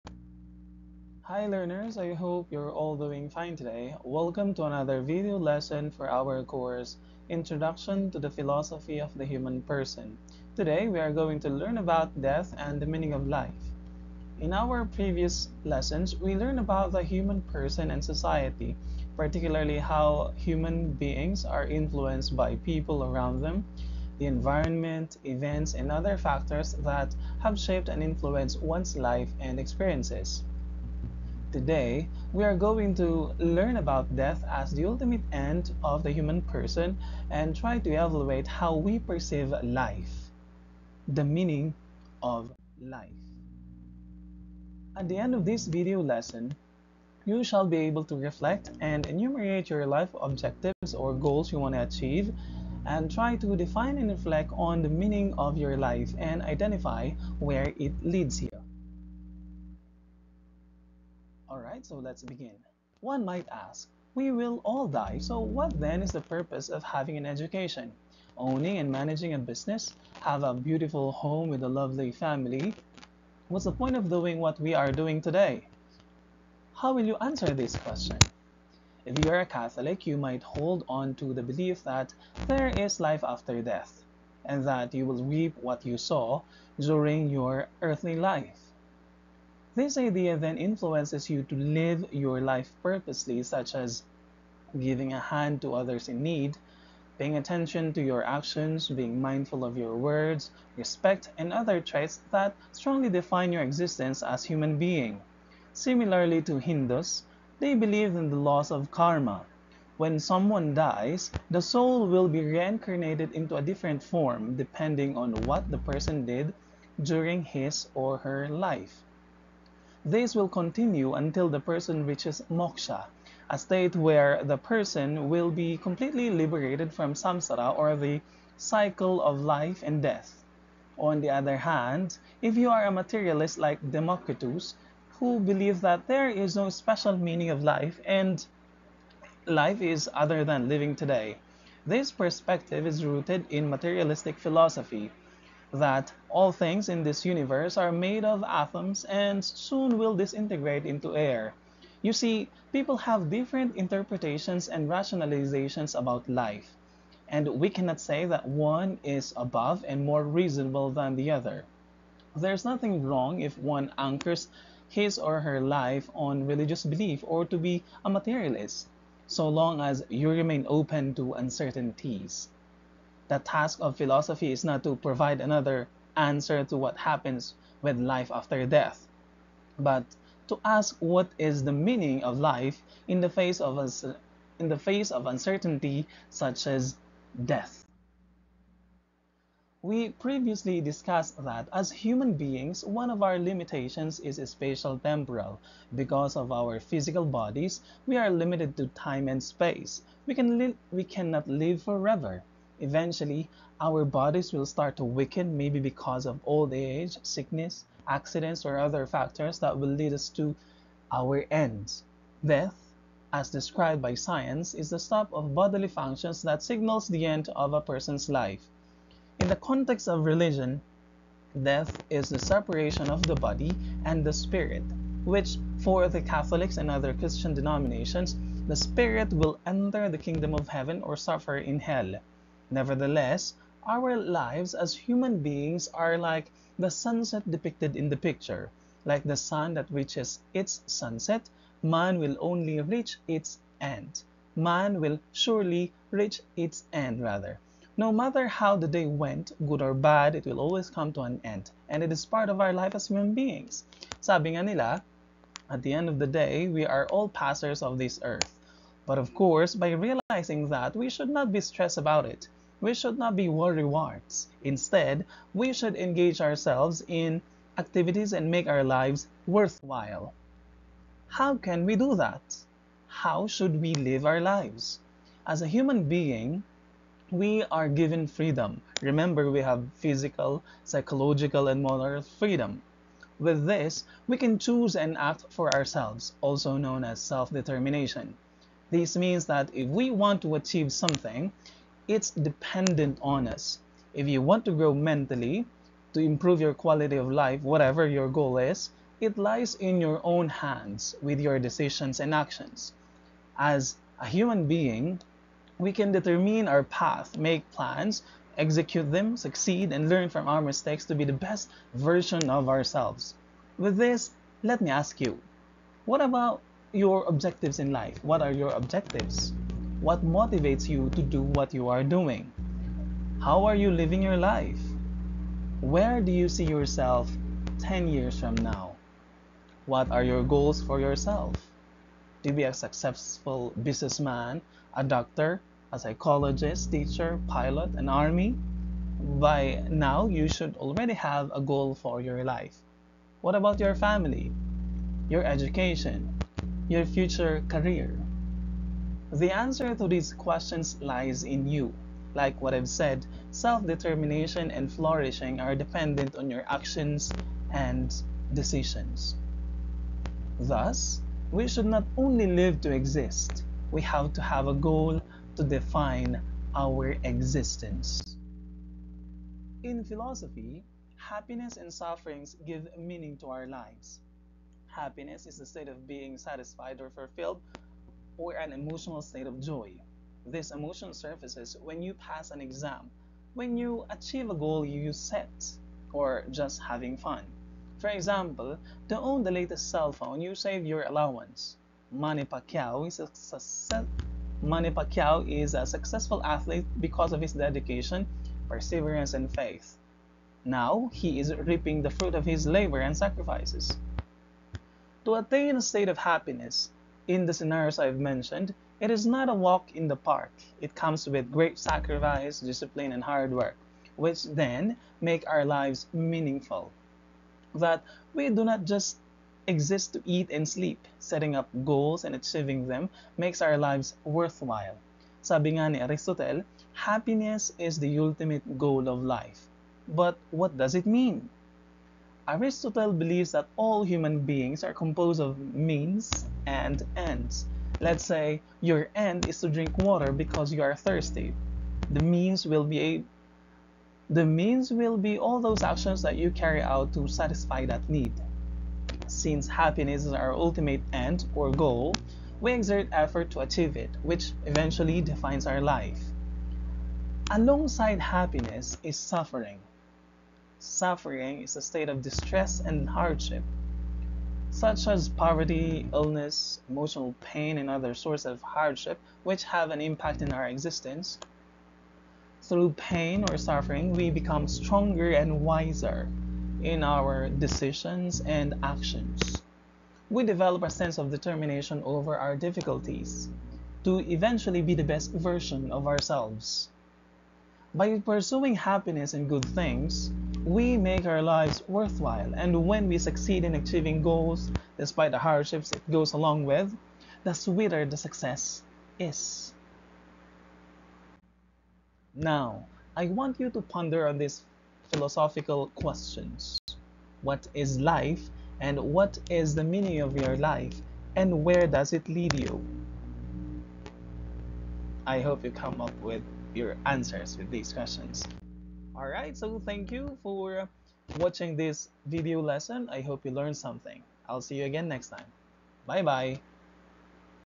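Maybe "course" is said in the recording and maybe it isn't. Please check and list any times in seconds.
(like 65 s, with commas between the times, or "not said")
6 s, 259 s.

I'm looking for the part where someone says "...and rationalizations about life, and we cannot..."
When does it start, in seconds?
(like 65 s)
154 s.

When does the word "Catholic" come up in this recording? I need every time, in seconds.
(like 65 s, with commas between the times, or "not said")
79 s, 226 s.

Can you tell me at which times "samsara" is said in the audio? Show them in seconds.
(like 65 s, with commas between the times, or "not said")
127 s.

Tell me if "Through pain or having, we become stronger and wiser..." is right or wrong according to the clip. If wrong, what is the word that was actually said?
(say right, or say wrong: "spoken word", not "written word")
wrong: "suffering", not "having".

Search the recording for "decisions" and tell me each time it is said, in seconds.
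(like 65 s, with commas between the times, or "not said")
301 s, 358 s, 477 s.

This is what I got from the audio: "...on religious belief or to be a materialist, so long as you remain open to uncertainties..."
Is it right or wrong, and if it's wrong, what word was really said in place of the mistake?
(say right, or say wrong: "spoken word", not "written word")
right.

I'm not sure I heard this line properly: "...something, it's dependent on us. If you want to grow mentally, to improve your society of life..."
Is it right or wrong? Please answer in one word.
wrong.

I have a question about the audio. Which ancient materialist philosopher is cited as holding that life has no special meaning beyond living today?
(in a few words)
Democritus.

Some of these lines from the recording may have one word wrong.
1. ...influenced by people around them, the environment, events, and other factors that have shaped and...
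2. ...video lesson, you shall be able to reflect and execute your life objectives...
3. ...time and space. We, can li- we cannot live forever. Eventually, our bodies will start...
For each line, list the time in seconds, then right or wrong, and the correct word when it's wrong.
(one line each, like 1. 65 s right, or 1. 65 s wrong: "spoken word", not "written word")
1. 21 s right
2. 45 s wrong: "enumerate", not "execute"
3. 198 s right.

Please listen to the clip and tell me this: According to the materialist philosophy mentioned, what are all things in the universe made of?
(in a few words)
atoms.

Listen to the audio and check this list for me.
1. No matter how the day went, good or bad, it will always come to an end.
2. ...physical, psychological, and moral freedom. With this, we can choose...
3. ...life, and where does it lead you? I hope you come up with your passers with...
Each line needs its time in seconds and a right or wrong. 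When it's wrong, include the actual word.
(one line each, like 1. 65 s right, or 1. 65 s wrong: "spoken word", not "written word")
1. 247 s right
2. 279 s right
3. 510 s wrong: "answers", not "passers".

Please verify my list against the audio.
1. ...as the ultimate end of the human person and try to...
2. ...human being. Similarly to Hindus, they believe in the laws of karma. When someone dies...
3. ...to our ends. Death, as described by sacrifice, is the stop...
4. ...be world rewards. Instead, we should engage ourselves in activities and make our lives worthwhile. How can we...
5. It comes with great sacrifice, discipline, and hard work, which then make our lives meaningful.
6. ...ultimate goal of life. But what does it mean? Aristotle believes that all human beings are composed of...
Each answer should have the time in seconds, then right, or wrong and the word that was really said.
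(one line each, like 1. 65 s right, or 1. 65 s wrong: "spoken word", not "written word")
1. 34 s right
2. 104 s right
3. 210 s wrong: "science", not "sacrifice"
4. 263 s right
5. 410 s right
6. 428 s right.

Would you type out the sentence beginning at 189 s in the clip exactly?
We previously discussed that as human beings, one of our limitations is spatial temporal.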